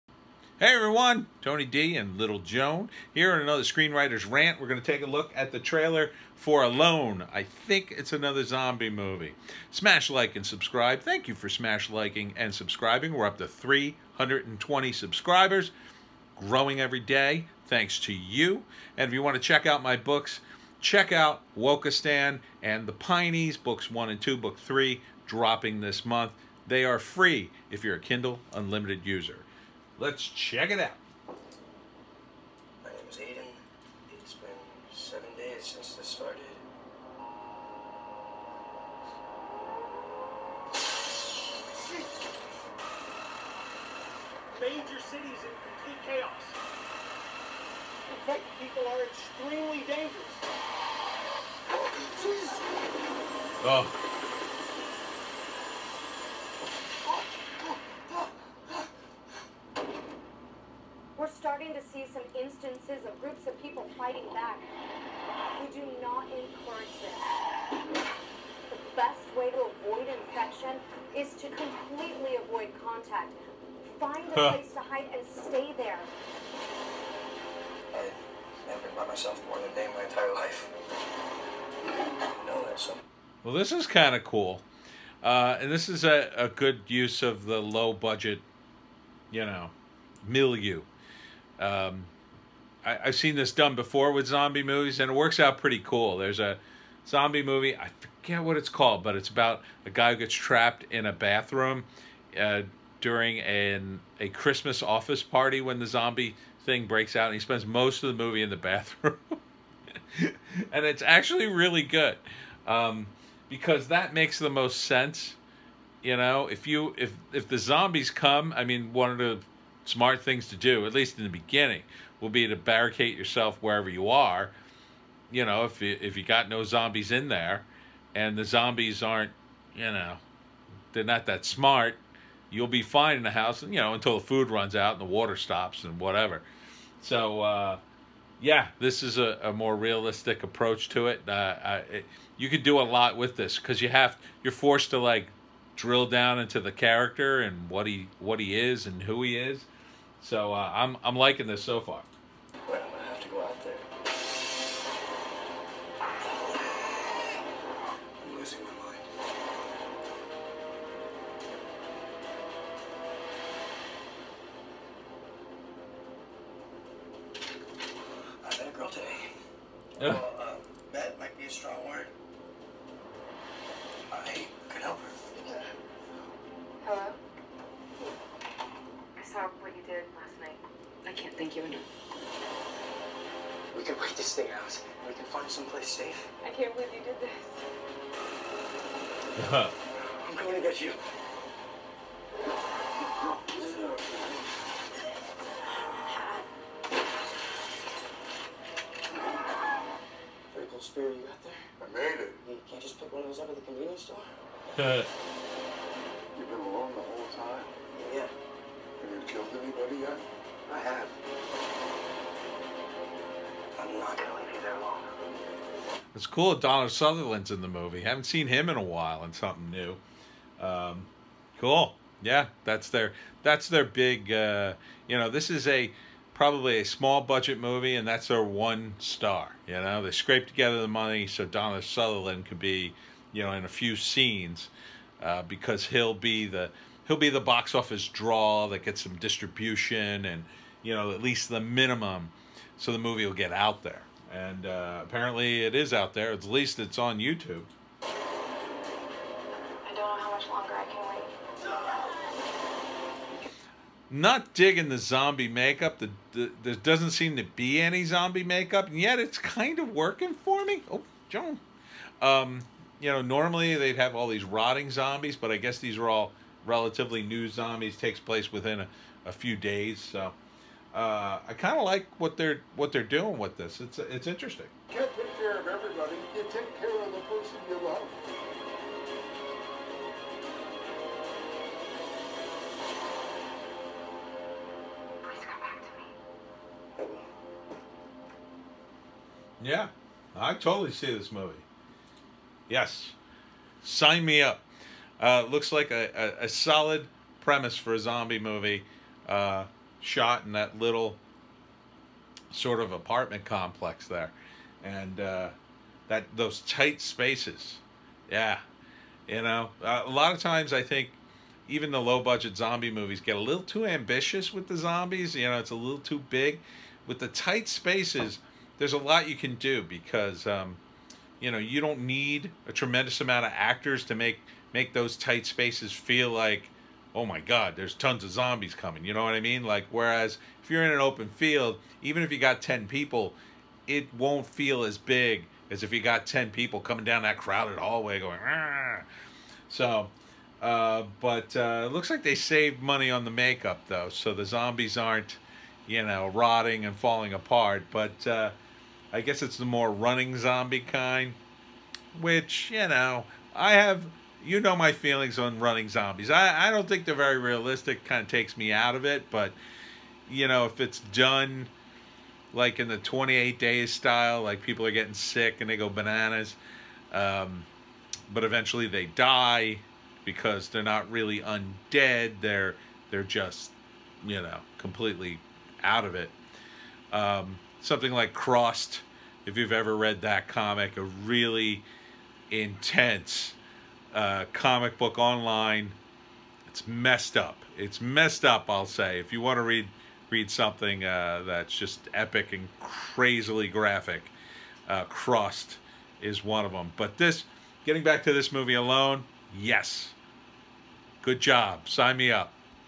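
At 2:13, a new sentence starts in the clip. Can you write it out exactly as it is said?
You know, until the food runs out and the water stops and whatever.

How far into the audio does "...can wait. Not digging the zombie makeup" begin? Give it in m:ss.
4:10.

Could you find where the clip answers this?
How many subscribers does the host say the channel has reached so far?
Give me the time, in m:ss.
0:13.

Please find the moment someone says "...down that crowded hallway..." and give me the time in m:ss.
5:37.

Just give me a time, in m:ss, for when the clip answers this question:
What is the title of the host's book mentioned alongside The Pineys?
0:21.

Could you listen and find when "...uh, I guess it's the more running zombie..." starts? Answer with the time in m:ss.
5:48.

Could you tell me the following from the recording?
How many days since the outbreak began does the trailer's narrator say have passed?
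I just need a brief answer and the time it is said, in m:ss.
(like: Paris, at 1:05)
7, at 0:34.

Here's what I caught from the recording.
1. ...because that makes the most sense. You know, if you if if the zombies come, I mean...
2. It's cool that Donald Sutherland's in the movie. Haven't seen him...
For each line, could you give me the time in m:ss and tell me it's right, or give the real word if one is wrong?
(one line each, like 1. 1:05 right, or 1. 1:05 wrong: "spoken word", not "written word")
1. 1:53 right
2. 3:36 right.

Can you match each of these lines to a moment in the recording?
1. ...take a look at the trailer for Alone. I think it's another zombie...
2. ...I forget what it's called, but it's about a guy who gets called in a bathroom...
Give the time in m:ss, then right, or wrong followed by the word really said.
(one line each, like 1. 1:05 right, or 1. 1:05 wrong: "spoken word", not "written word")
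1. 0:04 right
2. 1:37 wrong: "trapped", not "called".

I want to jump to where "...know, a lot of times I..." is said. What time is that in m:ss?
5:09.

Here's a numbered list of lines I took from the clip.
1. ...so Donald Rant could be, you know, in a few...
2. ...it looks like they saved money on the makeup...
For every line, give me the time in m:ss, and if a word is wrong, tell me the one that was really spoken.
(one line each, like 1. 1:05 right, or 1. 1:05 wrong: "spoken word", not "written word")
1. 3:51 wrong: "Sutherland", not "Rant"
2. 5:41 right.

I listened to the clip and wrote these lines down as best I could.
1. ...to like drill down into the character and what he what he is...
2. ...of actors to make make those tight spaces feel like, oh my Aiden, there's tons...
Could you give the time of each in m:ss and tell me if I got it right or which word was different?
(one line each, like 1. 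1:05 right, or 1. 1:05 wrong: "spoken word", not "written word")
1. 2:24 right
2. 5:23 wrong: "God", not "Aiden".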